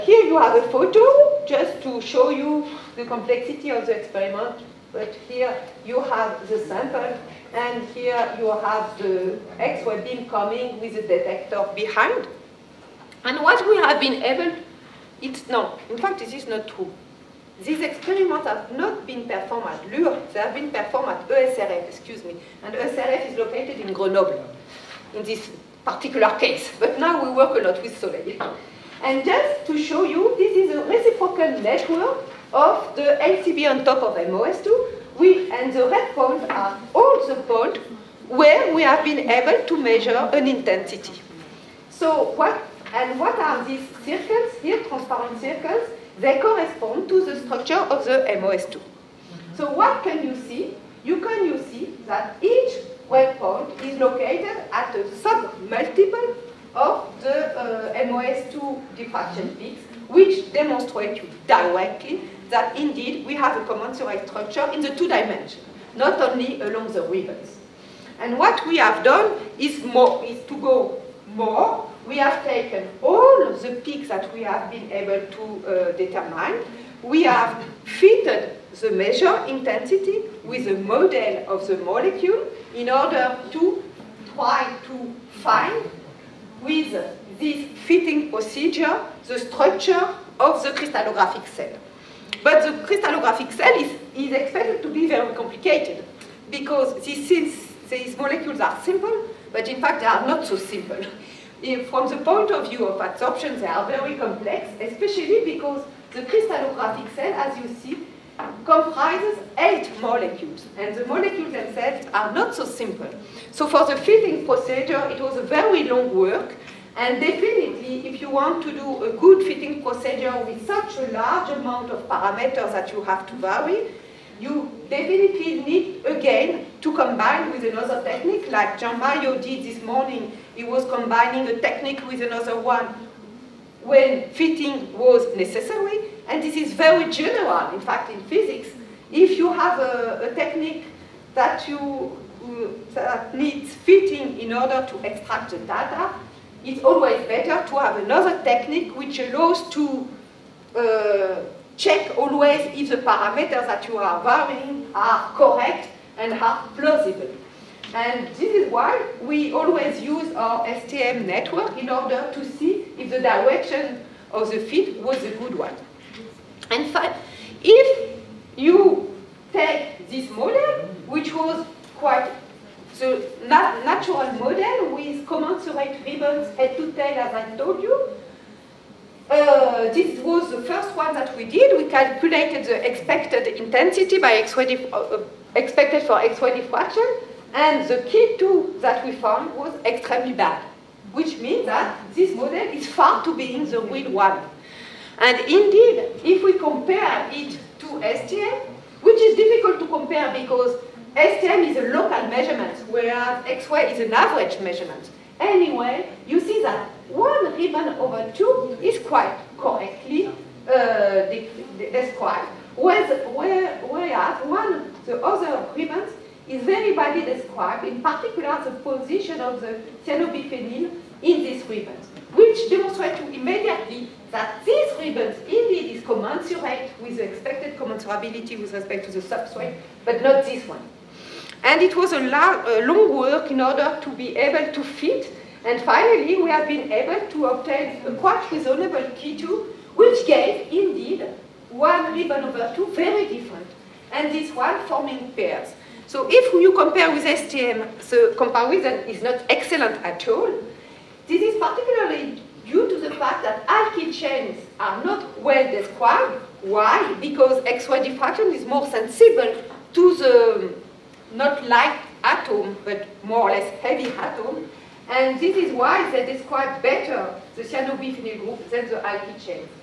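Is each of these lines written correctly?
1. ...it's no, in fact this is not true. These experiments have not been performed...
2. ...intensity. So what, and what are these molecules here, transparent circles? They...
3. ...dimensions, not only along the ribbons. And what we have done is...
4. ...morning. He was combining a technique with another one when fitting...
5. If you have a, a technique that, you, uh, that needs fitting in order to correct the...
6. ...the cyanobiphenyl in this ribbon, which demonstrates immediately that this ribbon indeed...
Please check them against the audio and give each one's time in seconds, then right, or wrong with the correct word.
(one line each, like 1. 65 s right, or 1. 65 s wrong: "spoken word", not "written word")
1. 15 s right
2. 40 s wrong: "circles", not "molecules"
3. 65 s right
4. 129 s right
5. 139 s wrong: "extract", not "correct"
6. 219 s right.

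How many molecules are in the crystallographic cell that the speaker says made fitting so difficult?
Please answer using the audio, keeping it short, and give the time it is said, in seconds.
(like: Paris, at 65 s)
8, at 109 s.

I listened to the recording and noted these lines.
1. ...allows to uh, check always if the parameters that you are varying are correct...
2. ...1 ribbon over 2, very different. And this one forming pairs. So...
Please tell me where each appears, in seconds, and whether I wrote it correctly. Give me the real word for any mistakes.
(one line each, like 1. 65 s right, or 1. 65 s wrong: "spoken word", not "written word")
1. 149 s right
2. 241 s right.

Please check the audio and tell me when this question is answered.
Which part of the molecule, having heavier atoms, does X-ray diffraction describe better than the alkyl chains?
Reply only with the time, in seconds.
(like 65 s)
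267 s.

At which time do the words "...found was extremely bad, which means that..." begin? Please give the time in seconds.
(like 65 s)
189 s.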